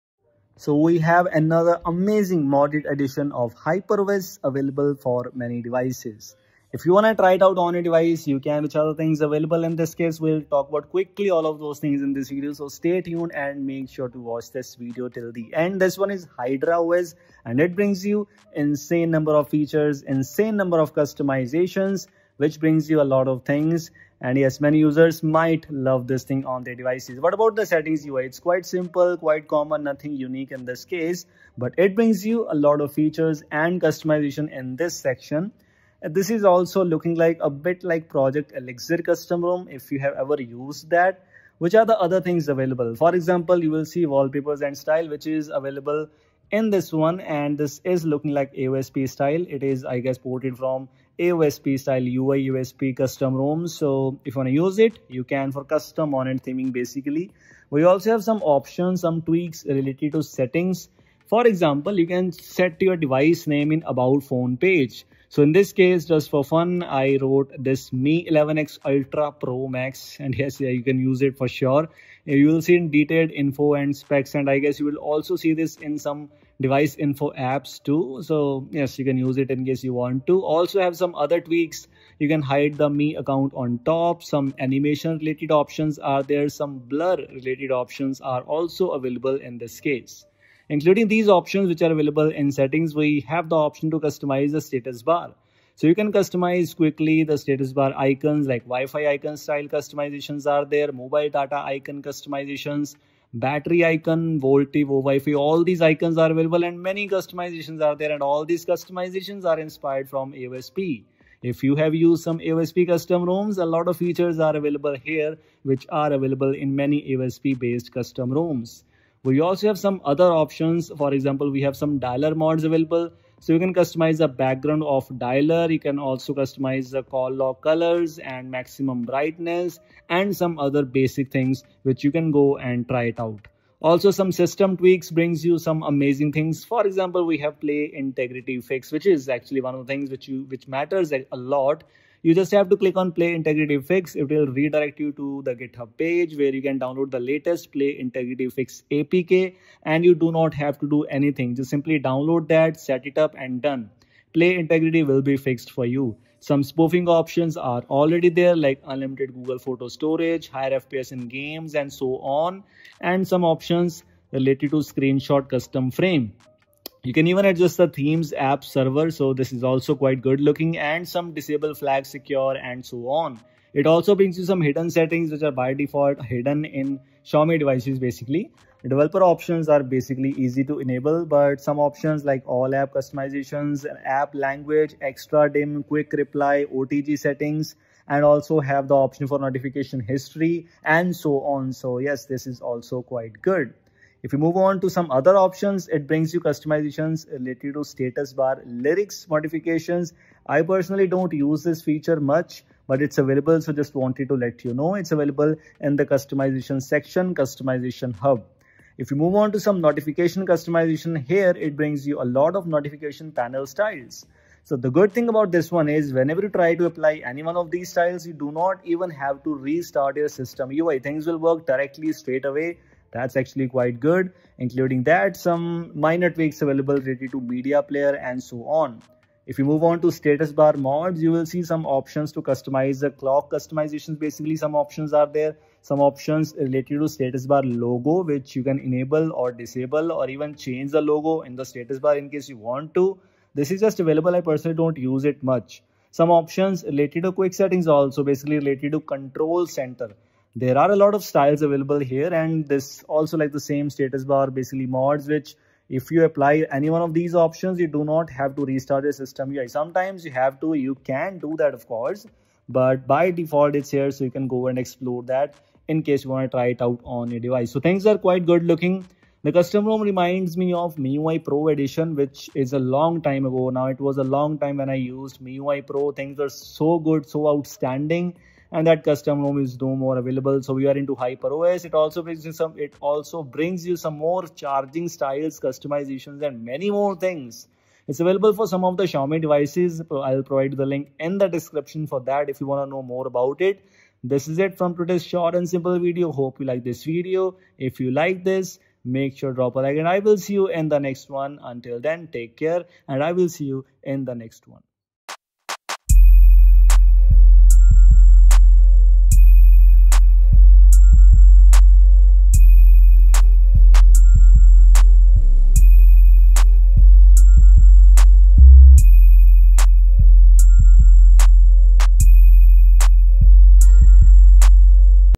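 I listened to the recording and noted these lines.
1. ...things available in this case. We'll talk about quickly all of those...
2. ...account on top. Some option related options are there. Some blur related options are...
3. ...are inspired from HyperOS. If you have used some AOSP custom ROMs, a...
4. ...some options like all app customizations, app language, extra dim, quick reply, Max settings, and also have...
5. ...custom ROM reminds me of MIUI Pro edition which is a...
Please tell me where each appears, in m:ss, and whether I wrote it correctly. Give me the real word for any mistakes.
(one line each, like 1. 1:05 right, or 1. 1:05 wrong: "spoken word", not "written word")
1. 0:08 right
2. 1:23 wrong: "animation", not "option"
3. 1:49 wrong: "AOSP", not "HyperOS"
4. 3:01 wrong: "OTG", not "Max"
5. 4:29 right.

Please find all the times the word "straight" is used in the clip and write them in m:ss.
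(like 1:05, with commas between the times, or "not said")
3:42.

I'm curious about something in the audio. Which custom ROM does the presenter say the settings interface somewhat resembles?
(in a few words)
Project Elixir.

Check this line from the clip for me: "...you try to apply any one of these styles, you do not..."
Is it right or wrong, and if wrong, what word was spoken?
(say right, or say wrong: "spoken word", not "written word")
right.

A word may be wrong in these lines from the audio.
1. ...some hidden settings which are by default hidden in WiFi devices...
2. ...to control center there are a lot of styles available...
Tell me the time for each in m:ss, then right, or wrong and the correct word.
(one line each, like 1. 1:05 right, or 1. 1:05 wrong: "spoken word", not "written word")
1. 2:54 wrong: "Xiaomi", not "WiFi"
2. 4:08 right.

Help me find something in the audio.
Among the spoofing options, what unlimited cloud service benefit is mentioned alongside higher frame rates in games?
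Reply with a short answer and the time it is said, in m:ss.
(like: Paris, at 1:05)
Google Photo storage, at 2:39.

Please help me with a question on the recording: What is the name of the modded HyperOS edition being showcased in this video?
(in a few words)
HydraOS.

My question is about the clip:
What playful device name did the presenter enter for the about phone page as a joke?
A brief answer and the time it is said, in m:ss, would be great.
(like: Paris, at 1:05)
Mi 11x Ultra Pro Max, at 1:07.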